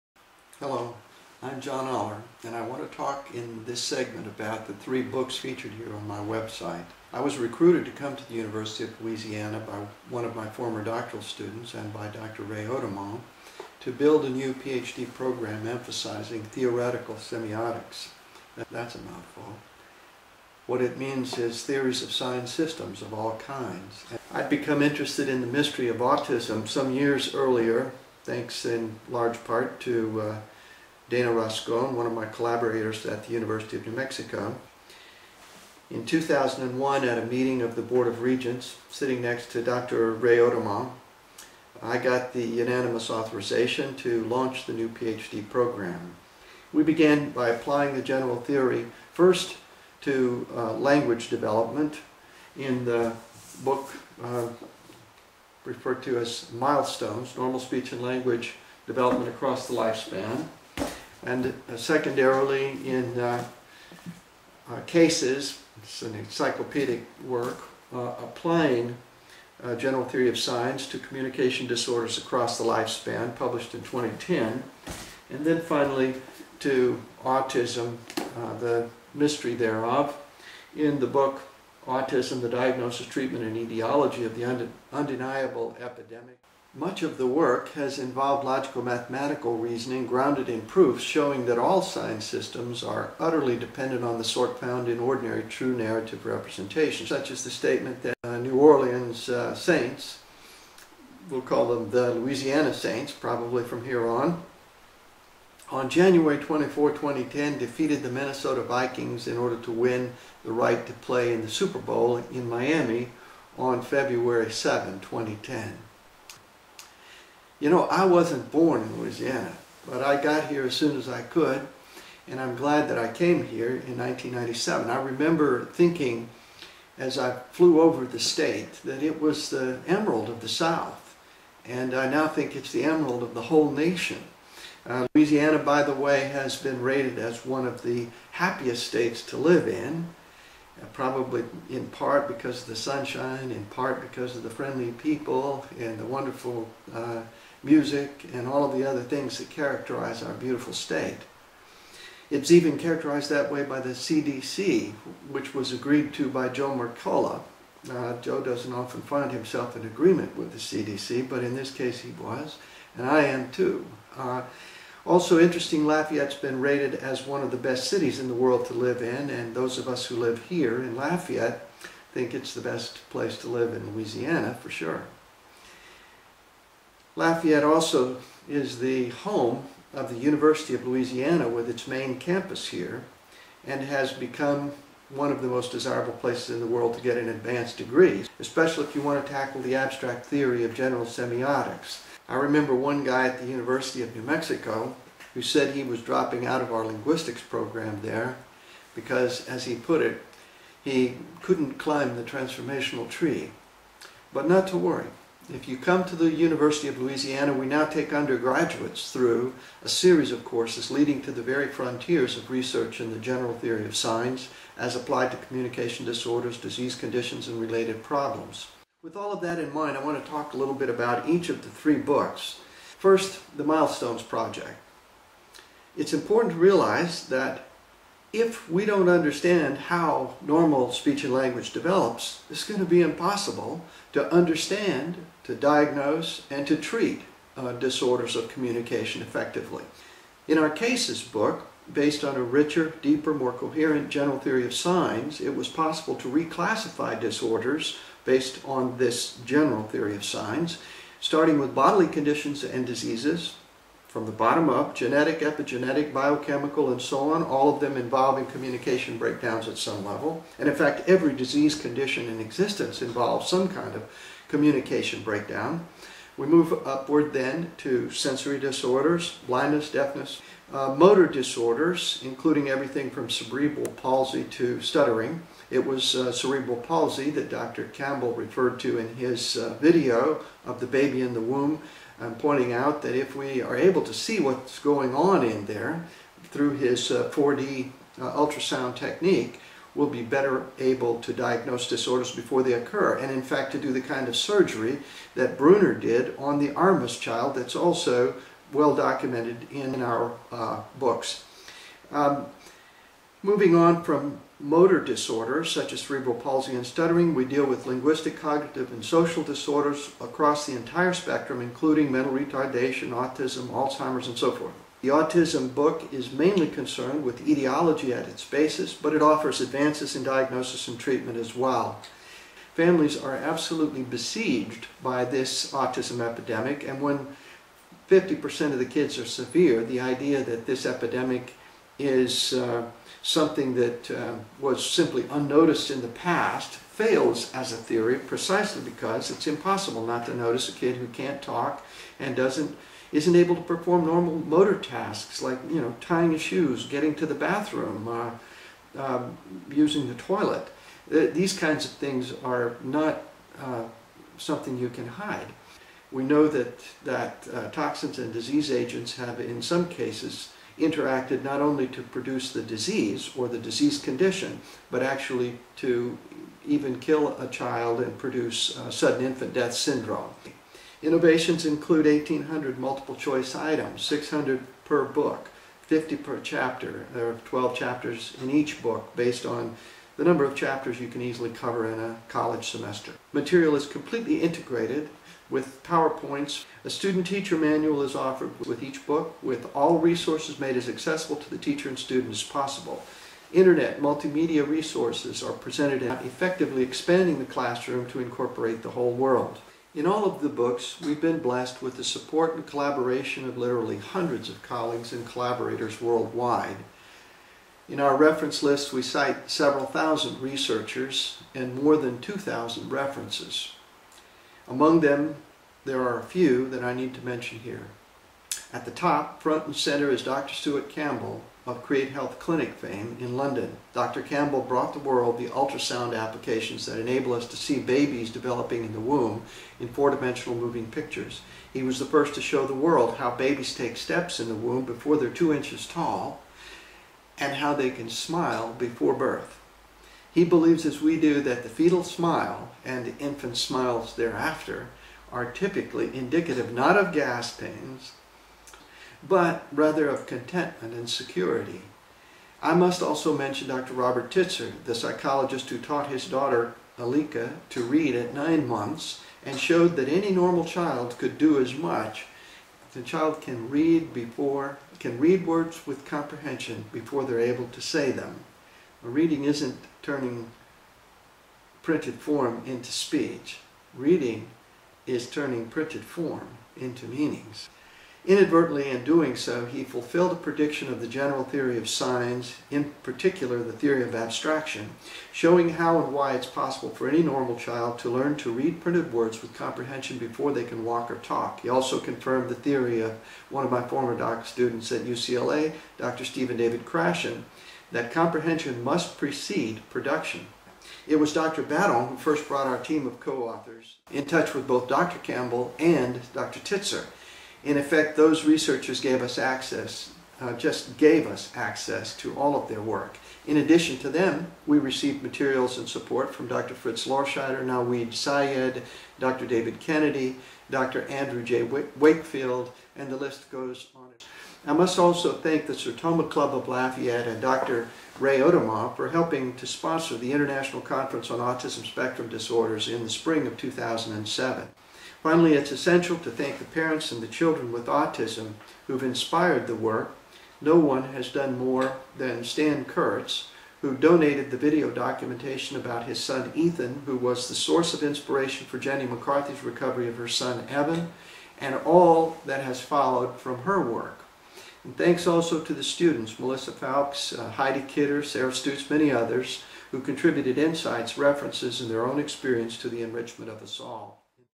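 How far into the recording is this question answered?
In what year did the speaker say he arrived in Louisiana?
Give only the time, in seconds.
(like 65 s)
123 s.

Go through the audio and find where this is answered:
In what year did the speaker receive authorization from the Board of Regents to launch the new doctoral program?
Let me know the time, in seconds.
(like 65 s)
36 s.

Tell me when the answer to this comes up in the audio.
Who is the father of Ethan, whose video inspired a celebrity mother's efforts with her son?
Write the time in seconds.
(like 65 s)
542 s.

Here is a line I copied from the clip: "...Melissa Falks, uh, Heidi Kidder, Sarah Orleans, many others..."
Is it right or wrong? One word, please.
wrong.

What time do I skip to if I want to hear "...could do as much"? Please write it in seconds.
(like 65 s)
461 s.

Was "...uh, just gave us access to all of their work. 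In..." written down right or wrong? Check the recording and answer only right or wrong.
right.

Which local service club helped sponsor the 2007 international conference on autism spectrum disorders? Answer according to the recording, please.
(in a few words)
Sertoma Club.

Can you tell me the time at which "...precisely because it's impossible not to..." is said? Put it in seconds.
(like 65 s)
338 s.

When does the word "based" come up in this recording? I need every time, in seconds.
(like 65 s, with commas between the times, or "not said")
241 s, 248 s, 379 s.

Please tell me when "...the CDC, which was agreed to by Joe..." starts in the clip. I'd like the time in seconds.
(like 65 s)
153 s.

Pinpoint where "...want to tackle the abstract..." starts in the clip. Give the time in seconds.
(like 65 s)
189 s.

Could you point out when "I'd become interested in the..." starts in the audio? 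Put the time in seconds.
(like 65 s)
24 s.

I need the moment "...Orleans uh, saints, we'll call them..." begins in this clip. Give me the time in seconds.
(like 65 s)
98 s.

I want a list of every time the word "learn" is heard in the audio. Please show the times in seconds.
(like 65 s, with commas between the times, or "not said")
488 s.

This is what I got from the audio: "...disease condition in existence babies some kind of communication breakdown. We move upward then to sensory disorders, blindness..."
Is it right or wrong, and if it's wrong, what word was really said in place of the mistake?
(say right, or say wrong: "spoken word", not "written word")
wrong: "involves", not "babies".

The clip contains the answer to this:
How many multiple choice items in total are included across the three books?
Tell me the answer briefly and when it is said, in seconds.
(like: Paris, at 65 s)
1,800, at 372 s.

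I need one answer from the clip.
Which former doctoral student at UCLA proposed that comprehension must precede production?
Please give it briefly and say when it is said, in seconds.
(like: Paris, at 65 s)
Stephen David Krashen, at 496 s.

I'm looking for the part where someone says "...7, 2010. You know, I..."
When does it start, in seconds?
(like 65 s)
114 s.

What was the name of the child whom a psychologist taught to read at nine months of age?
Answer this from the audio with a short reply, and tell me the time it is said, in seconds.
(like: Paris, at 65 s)
Aleka, at 456 s.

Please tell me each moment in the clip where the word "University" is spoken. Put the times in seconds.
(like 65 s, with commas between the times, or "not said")
8 s, 33 s, 180 s, 193 s, 206 s.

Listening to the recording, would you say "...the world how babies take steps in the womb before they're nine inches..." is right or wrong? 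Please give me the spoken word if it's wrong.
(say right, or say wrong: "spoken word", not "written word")
wrong: "two", not "nine".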